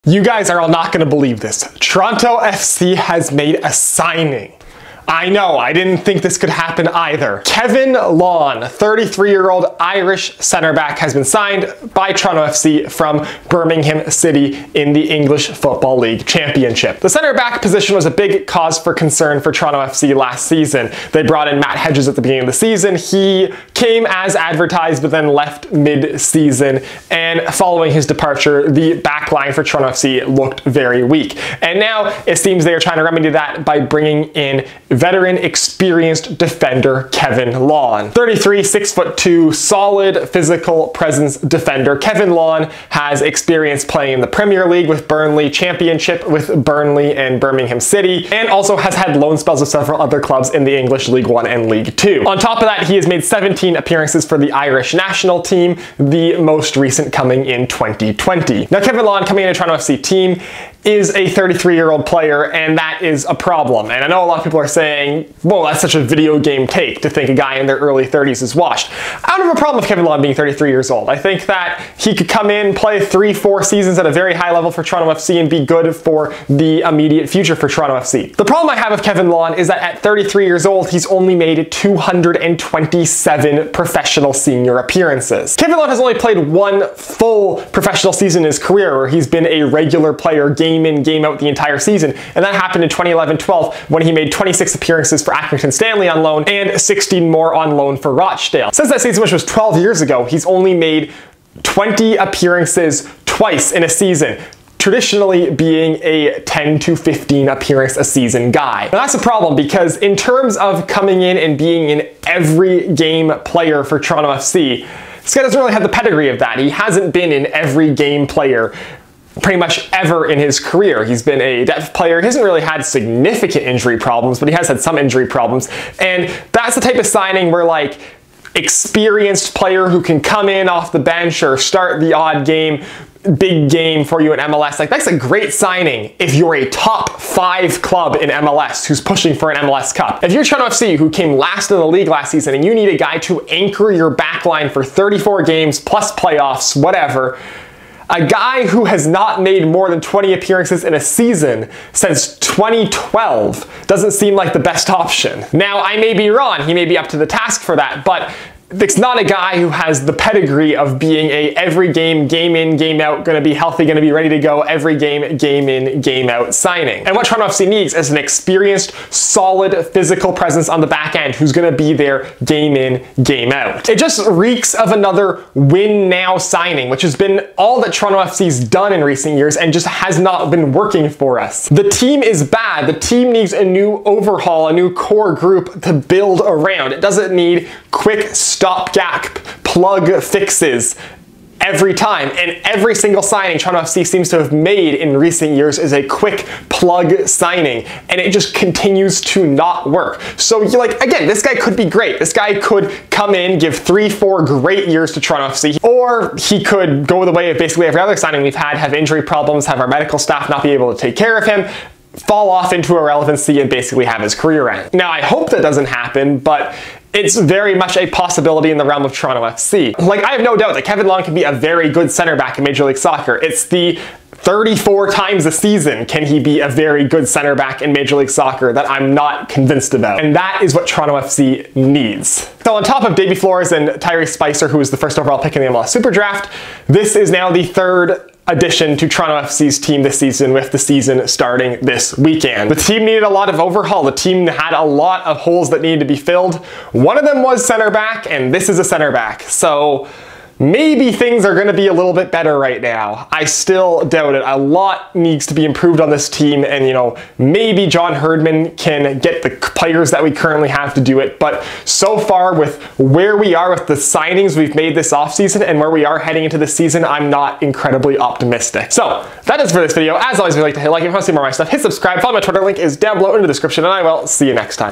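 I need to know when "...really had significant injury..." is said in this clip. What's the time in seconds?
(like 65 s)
122 s.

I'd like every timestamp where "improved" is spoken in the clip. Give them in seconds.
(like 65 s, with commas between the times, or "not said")
255 s.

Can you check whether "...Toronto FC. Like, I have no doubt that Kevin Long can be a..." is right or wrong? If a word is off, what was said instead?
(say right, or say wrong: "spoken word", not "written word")
right.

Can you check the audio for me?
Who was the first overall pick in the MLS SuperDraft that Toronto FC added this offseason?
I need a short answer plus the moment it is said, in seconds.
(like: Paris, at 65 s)
Tyrese Spicer, at 234 s.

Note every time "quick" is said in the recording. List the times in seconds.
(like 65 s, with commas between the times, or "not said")
187 s, 196 s.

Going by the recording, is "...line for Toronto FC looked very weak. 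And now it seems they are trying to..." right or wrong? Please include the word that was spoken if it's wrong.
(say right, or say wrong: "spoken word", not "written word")
right.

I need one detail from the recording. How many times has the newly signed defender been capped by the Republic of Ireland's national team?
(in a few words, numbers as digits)
17.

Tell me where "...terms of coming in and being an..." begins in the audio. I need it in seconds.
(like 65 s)
110 s.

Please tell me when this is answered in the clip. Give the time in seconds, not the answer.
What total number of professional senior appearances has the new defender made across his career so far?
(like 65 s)
81 s.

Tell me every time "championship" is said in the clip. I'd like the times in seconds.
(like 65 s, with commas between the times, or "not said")
16 s, 45 s.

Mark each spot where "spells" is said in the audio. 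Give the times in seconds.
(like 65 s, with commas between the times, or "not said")
49 s.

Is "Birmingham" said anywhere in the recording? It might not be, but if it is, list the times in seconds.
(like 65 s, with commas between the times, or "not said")
13 s, 47 s.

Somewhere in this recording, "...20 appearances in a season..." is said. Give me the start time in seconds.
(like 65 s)
150 s.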